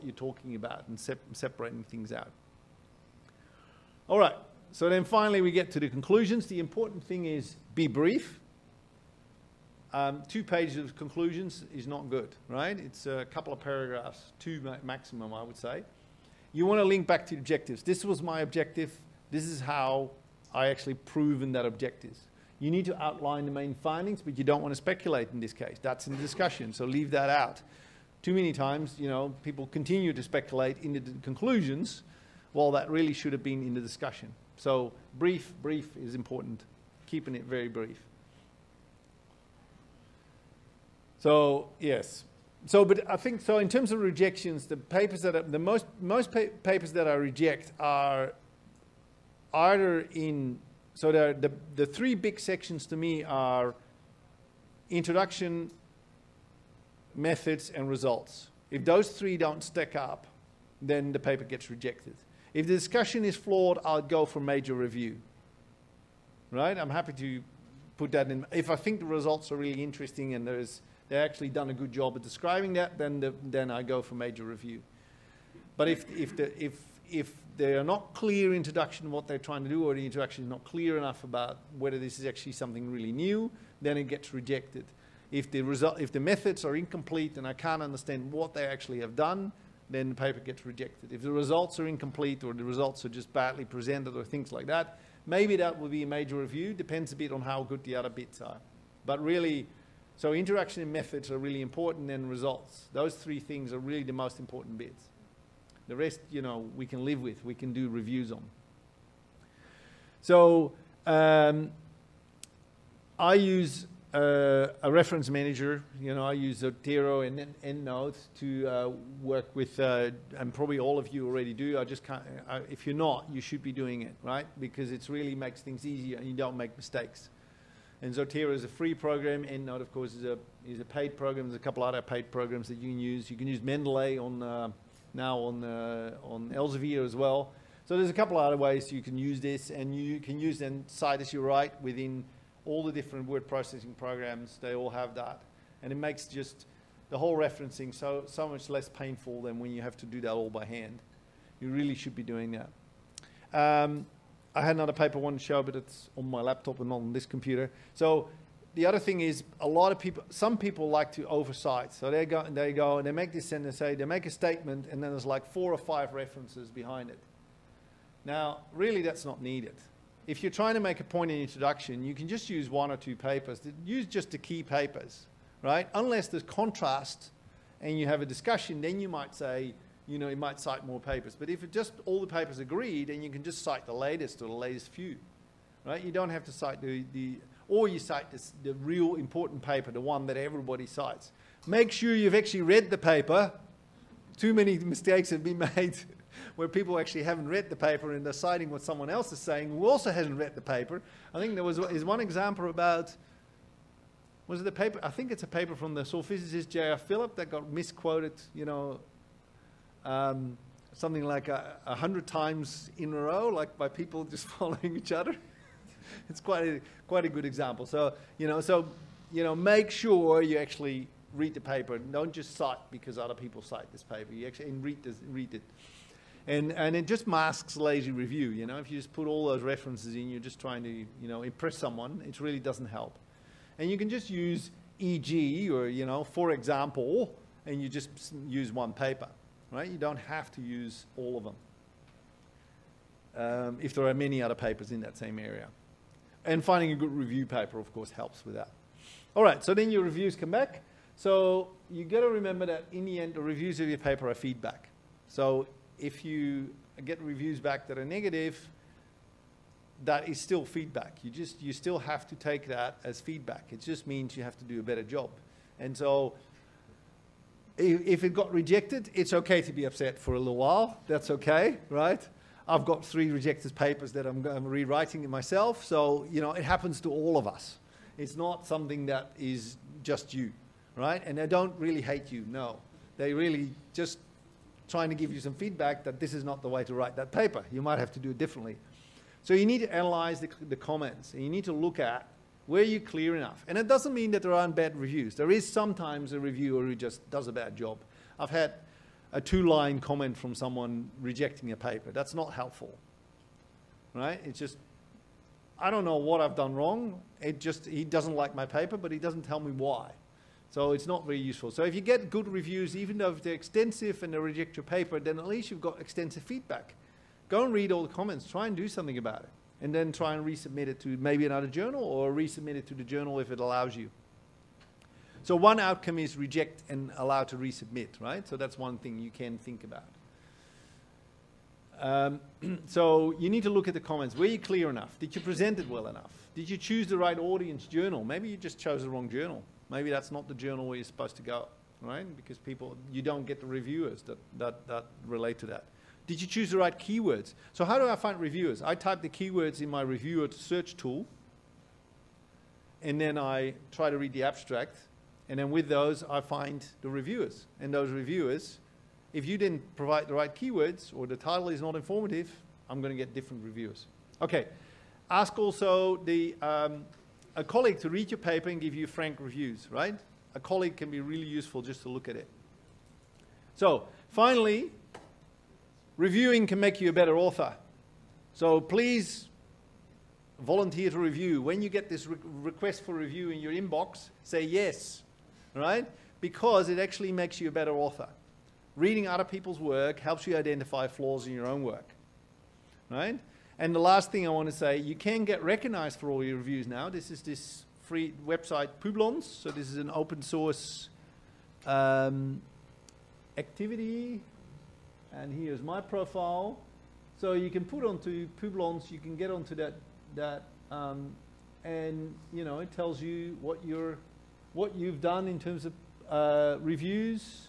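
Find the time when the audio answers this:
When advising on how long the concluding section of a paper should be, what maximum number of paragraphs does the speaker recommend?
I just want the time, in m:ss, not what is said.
0:14.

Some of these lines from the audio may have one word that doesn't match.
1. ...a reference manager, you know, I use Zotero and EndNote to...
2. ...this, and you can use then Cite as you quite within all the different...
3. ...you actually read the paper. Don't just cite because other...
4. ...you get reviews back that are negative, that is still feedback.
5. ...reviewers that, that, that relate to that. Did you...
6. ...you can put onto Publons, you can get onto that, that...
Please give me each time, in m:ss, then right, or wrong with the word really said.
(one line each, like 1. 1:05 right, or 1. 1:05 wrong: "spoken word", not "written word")
1. 1:54 right
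2. 2:19 wrong: "write", not "quite"
3. 3:40 right
4. 4:16 right
5. 5:43 right
6. 6:47 right.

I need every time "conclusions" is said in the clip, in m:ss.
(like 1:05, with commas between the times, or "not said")
0:05, 0:10, 0:31.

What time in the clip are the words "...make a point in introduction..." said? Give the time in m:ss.
2:50.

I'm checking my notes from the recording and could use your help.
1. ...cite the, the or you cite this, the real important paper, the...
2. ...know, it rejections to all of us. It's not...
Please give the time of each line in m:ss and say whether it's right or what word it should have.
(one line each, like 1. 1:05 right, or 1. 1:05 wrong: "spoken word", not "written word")
1. 3:06 right
2. 4:36 wrong: "happens", not "rejections".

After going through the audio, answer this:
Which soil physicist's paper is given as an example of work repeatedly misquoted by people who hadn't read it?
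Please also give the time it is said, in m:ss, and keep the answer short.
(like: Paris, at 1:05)
J.R. Philip, at 3:26.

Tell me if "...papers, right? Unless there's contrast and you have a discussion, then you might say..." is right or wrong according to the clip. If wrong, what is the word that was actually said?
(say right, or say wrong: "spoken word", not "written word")
right.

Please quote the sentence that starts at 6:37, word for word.
This is this free website Publons.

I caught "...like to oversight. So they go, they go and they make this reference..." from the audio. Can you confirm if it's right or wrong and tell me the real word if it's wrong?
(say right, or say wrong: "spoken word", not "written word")
wrong: "sentence", not "reference".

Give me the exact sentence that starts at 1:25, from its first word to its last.
If the, result, if the methods are incomplete and I can't understand what they actually have done, then the paper gets rejected.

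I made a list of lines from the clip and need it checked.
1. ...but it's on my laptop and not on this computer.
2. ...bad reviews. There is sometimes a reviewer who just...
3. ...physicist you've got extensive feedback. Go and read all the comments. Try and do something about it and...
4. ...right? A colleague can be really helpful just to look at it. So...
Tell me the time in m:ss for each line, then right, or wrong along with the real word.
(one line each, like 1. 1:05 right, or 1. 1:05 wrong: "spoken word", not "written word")
1. 2:35 right
2. 4:54 right
3. 5:15 wrong: "least", not "physicist"
4. 6:09 wrong: "useful", not "helpful".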